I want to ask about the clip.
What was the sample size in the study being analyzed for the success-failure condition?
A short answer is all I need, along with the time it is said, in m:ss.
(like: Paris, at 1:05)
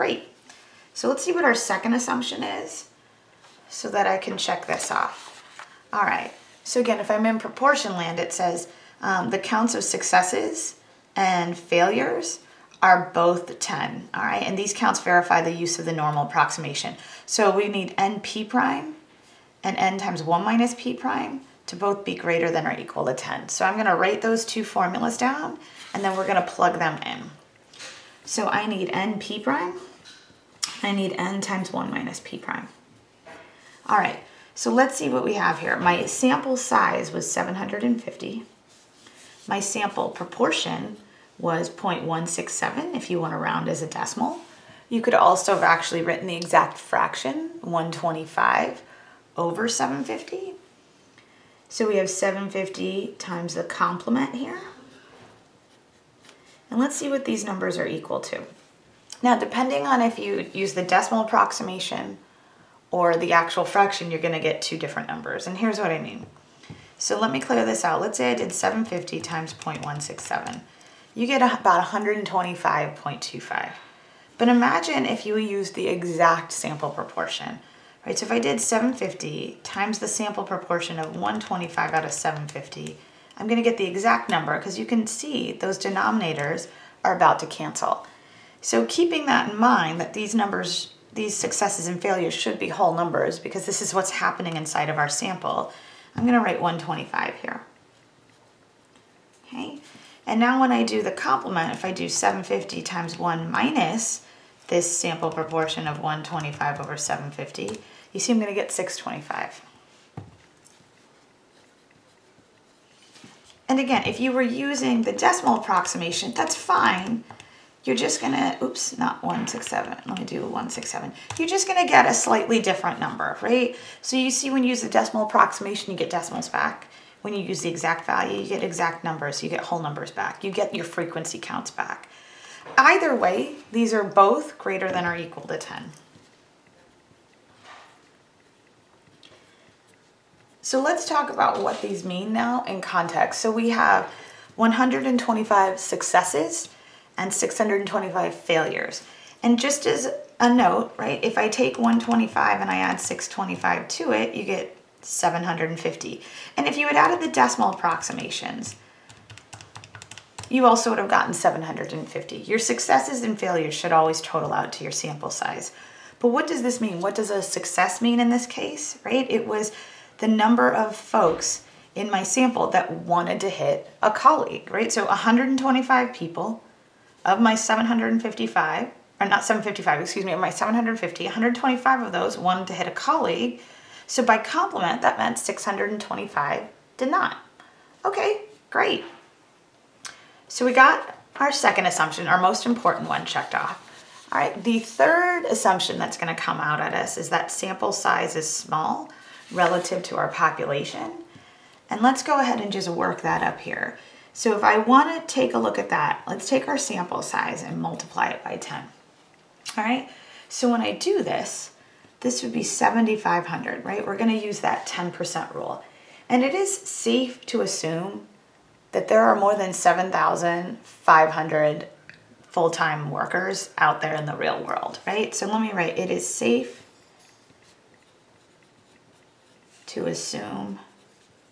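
750, at 0:35.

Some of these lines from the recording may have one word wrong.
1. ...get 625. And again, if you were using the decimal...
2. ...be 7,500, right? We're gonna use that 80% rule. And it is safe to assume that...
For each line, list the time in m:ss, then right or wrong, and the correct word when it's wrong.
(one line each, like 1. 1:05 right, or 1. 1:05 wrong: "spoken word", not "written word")
1. 1:48 right
2. 3:32 wrong: "10", not "80".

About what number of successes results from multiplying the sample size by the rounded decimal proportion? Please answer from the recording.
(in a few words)
125.25.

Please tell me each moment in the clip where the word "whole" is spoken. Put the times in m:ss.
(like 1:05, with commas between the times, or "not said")
1:32, 2:09.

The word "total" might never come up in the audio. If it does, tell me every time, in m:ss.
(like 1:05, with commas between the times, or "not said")
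2:44.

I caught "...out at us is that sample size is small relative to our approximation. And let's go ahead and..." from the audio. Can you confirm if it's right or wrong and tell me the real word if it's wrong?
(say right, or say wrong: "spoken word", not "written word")
wrong: "population", not "approximation".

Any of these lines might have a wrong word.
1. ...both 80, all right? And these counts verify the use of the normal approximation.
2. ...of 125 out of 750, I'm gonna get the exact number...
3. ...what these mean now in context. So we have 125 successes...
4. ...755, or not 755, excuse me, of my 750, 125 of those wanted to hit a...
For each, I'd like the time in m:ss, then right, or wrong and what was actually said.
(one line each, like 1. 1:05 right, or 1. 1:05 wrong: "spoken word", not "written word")
1. 0:13 wrong: "10", not "80"
2. 1:20 right
3. 2:21 right
4. 2:57 right.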